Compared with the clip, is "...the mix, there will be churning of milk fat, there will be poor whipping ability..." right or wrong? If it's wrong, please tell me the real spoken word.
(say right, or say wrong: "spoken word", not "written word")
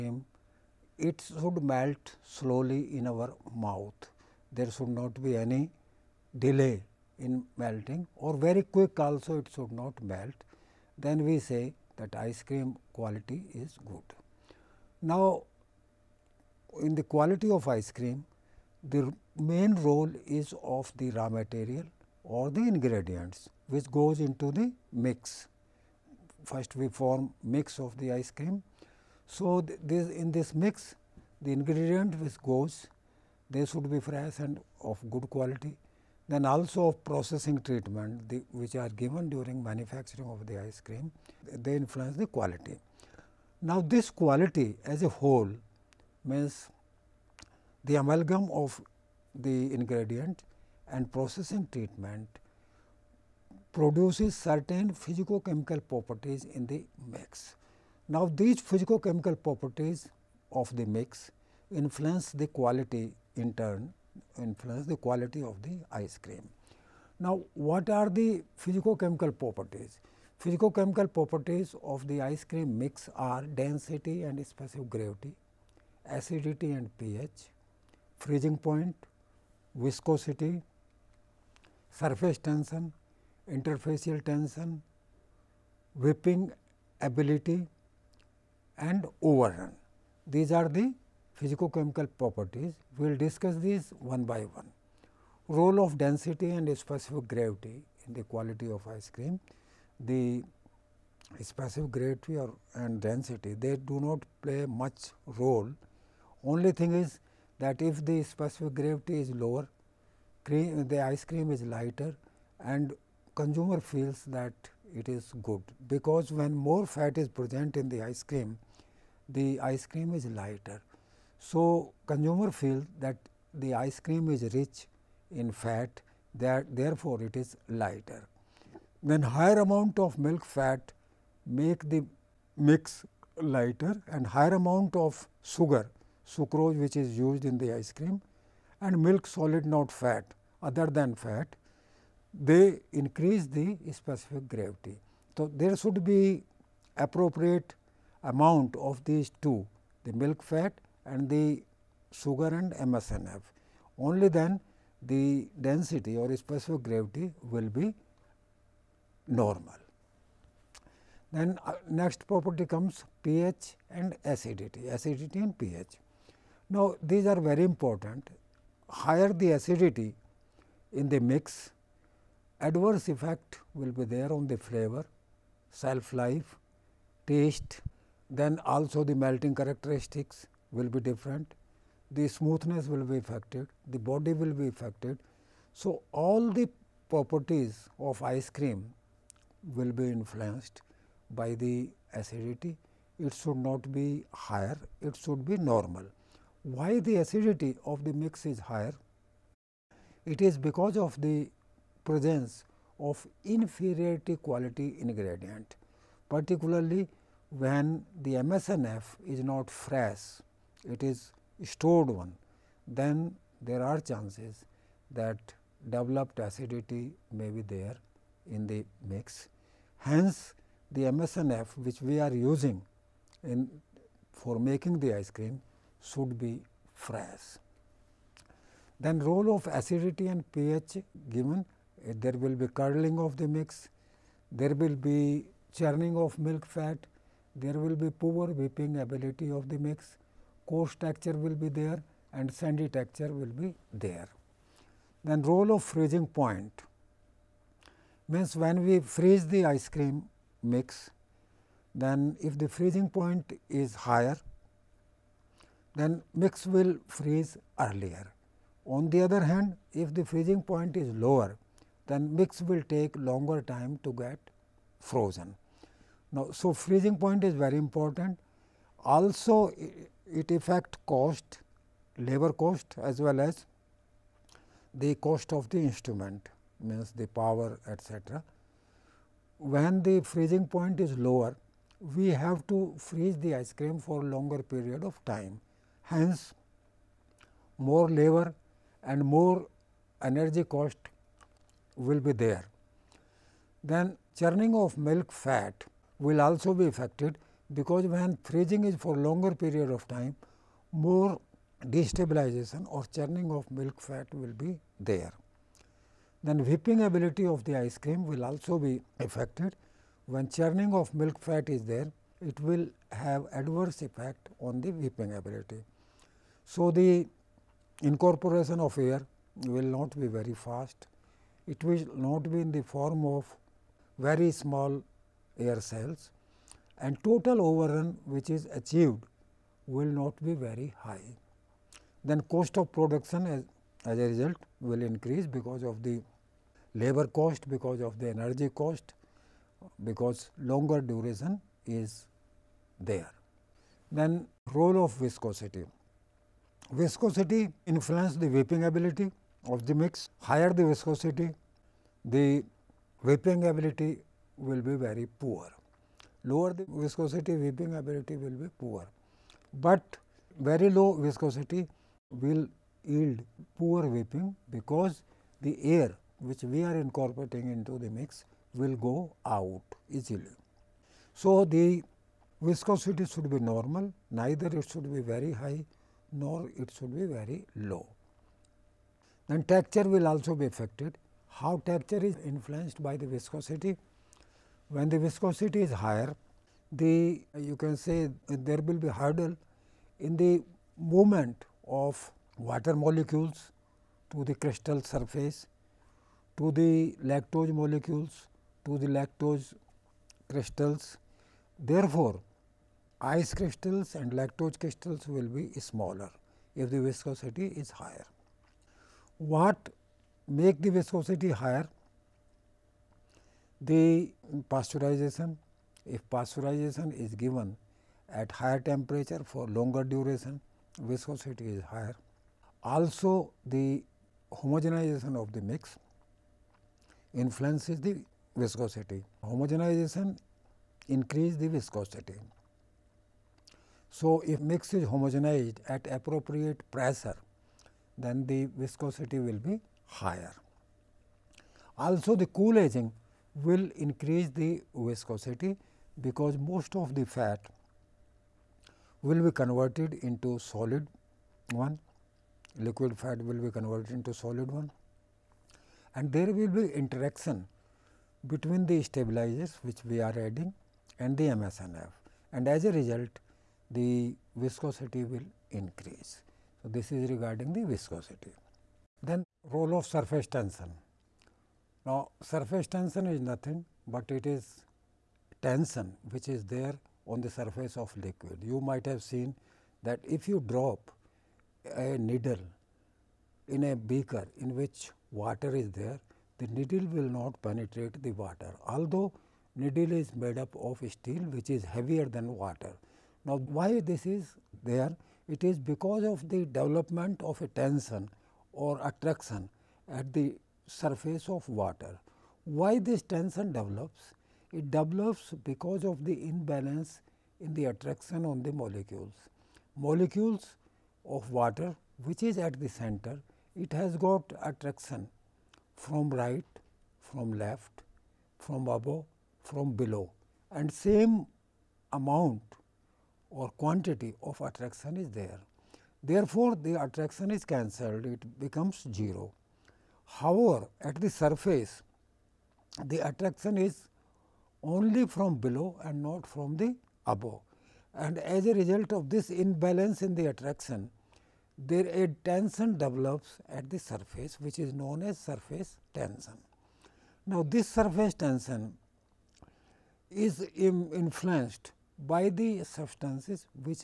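right.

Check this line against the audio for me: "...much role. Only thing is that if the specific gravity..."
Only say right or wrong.
right.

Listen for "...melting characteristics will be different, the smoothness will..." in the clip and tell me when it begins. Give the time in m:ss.
2:59.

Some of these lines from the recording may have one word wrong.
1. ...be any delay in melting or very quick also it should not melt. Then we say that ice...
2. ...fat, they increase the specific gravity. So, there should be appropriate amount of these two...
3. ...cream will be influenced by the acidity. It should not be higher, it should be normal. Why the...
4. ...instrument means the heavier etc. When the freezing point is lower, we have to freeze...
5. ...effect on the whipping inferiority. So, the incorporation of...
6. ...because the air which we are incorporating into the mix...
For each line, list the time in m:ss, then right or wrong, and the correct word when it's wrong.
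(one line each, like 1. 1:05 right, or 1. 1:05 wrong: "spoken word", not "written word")
1. 0:05 right
2. 2:21 right
3. 3:08 right
4. 4:35 wrong: "power", not "heavier"
5. 5:14 wrong: "ability", not "inferiority"
6. 6:04 right.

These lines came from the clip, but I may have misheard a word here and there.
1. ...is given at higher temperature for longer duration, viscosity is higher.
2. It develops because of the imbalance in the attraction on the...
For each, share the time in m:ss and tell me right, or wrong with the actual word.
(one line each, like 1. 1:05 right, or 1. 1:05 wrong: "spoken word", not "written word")
1. 6:57 right
2. 8:24 right.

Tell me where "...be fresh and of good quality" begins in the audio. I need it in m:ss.
0:33.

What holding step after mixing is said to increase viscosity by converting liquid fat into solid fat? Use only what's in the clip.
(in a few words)
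Cool aging.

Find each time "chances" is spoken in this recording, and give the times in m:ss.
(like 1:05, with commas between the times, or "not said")
3:34.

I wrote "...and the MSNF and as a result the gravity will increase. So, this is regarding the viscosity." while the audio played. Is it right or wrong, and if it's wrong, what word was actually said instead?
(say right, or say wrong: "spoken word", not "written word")
wrong: "viscosity", not "gravity".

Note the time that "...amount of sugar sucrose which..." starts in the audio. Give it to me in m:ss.
2:14.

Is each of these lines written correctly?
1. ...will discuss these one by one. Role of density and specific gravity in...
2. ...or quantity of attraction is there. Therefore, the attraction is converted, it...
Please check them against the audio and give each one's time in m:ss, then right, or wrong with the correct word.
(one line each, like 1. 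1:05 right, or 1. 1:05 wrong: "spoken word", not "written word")
1. 1:33 right
2. 8:43 wrong: "cancelled", not "converted".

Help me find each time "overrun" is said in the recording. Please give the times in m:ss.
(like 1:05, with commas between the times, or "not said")
1:29, 5:27.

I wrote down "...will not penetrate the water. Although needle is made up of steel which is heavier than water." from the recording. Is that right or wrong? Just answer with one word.
right.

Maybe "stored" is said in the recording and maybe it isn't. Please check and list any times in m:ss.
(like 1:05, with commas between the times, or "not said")
3:31.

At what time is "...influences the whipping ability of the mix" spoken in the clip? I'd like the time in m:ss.
5:47.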